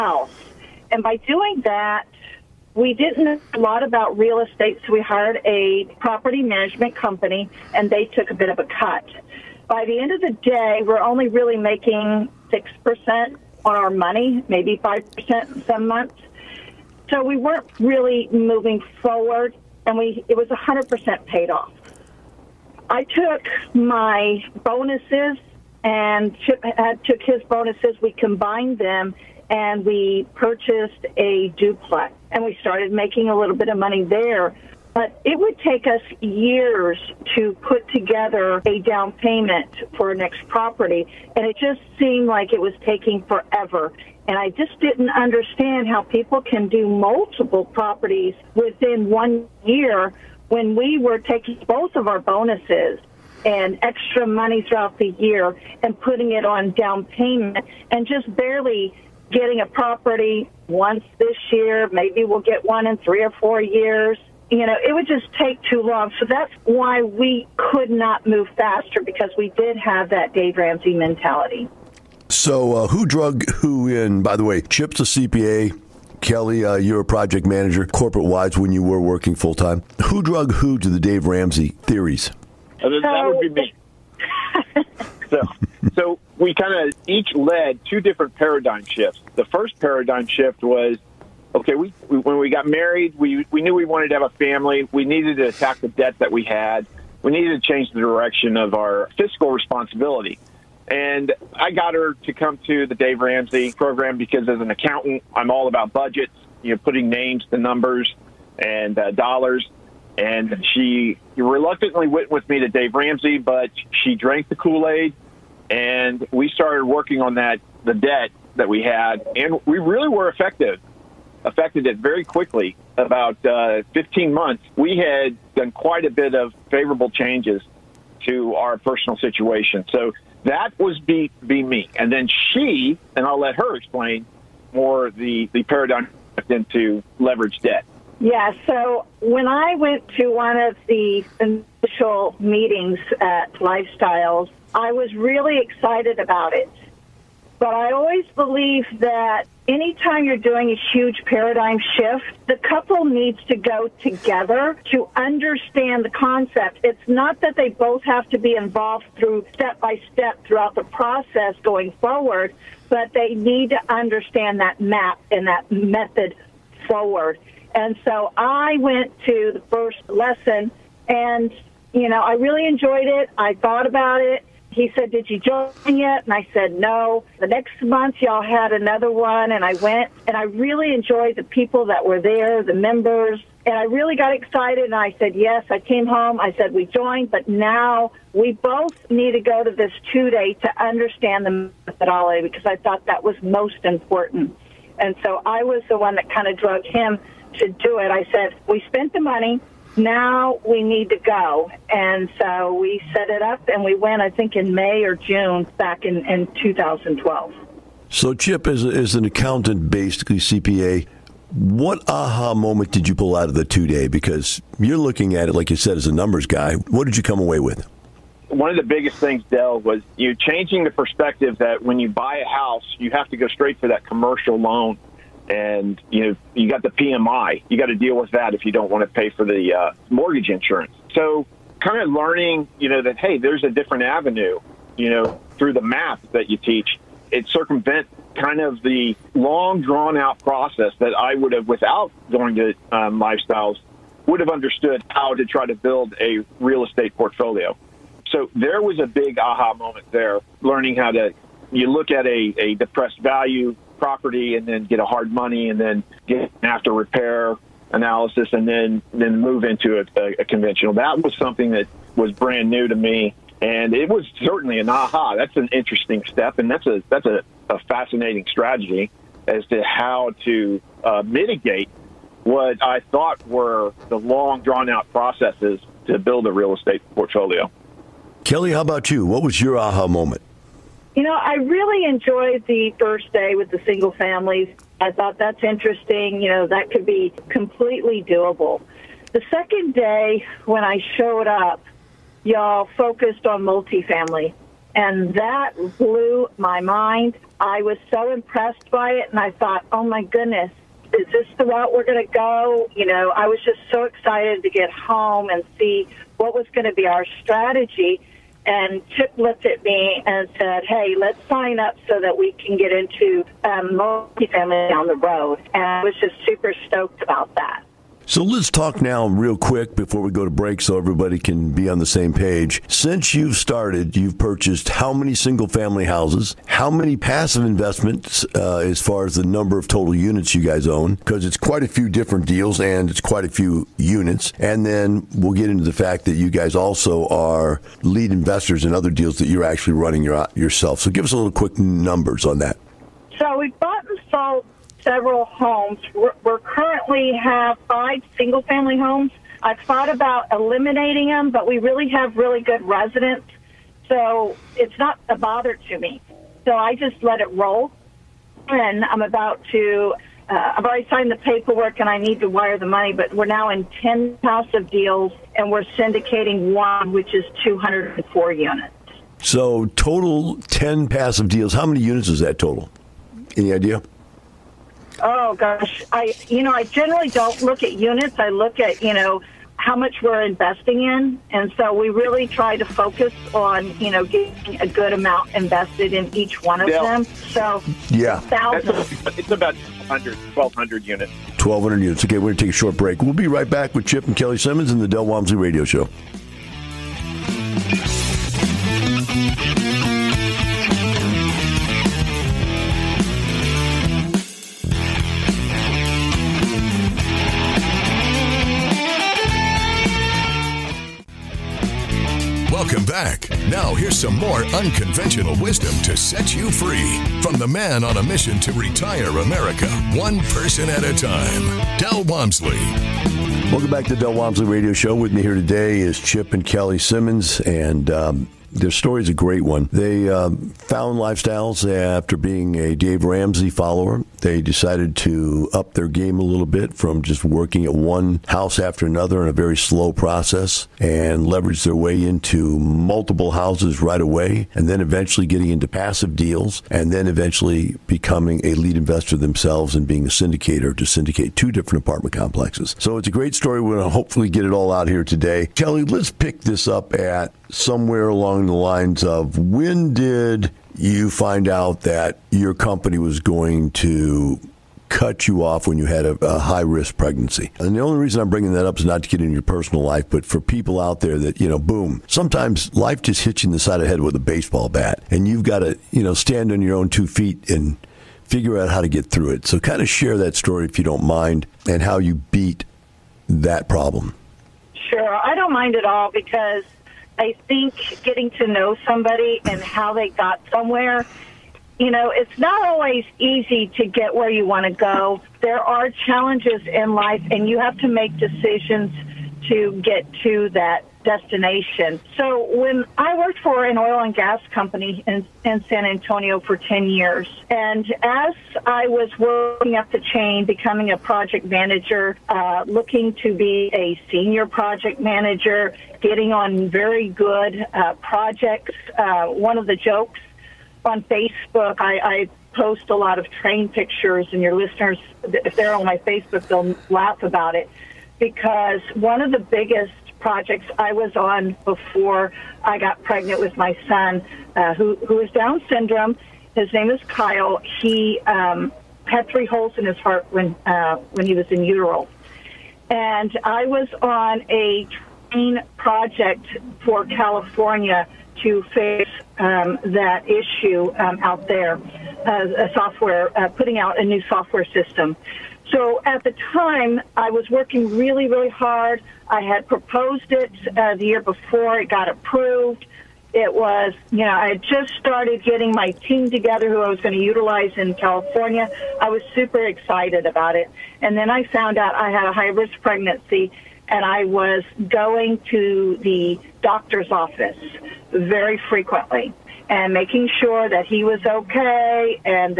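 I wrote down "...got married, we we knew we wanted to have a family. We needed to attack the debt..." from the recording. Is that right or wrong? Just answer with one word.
right.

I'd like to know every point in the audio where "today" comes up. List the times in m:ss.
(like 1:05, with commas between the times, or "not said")
7:05, 7:35.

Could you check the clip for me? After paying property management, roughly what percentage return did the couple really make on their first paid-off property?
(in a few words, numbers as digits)
6%.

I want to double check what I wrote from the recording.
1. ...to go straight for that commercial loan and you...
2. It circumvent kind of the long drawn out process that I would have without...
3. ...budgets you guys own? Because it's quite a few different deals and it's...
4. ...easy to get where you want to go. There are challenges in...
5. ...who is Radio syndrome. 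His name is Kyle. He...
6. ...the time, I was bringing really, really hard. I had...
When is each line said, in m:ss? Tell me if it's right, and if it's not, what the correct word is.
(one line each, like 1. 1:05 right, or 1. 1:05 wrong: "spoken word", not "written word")
1. 3:43 right
2. 3:57 right
3. 5:30 wrong: "units", not "budgets"
4. 8:13 right
5. 8:55 wrong: "Down", not "Radio"
6. 9:16 wrong: "working", not "bringing".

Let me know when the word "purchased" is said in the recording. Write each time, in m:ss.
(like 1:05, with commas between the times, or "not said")
0:30, 5:24.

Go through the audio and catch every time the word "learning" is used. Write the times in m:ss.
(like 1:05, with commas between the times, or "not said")
3:52, 4:10.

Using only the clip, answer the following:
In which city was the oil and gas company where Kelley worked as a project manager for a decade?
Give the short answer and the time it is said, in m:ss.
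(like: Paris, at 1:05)
San Antonio, at 8:25.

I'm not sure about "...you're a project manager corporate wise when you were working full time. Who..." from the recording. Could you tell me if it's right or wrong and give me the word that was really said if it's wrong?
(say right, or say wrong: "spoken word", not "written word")
right.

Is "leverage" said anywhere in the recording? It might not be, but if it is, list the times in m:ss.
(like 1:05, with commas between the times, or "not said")
2:17, 7:21.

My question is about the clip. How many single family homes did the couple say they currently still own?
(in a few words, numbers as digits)
5.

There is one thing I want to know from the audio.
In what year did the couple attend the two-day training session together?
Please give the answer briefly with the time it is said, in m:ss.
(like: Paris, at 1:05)
2012, at 3:26.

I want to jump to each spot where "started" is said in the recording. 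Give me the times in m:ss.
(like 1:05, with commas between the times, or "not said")
0:32, 1:56, 5:23, 9:25.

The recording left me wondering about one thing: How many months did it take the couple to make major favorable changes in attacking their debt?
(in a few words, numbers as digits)
15.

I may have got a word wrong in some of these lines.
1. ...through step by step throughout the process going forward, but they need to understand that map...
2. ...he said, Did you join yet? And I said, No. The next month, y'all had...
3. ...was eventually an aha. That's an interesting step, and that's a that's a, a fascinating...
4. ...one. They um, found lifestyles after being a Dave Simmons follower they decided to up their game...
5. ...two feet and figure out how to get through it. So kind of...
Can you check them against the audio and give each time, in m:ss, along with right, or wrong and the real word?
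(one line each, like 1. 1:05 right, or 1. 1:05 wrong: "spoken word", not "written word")
1. 2:39 right
2. 2:54 right
3. 4:24 wrong: "certainly", not "eventually"
4. 7:09 wrong: "Ramsey", not "Simmons"
5. 7:57 right.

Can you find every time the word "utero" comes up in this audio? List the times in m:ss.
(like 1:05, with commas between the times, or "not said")
9:01.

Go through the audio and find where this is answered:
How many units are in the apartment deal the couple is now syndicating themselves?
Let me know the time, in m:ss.
6:07.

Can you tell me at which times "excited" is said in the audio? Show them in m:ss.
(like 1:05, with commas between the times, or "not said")
2:25, 3:04, 5:04, 9:29.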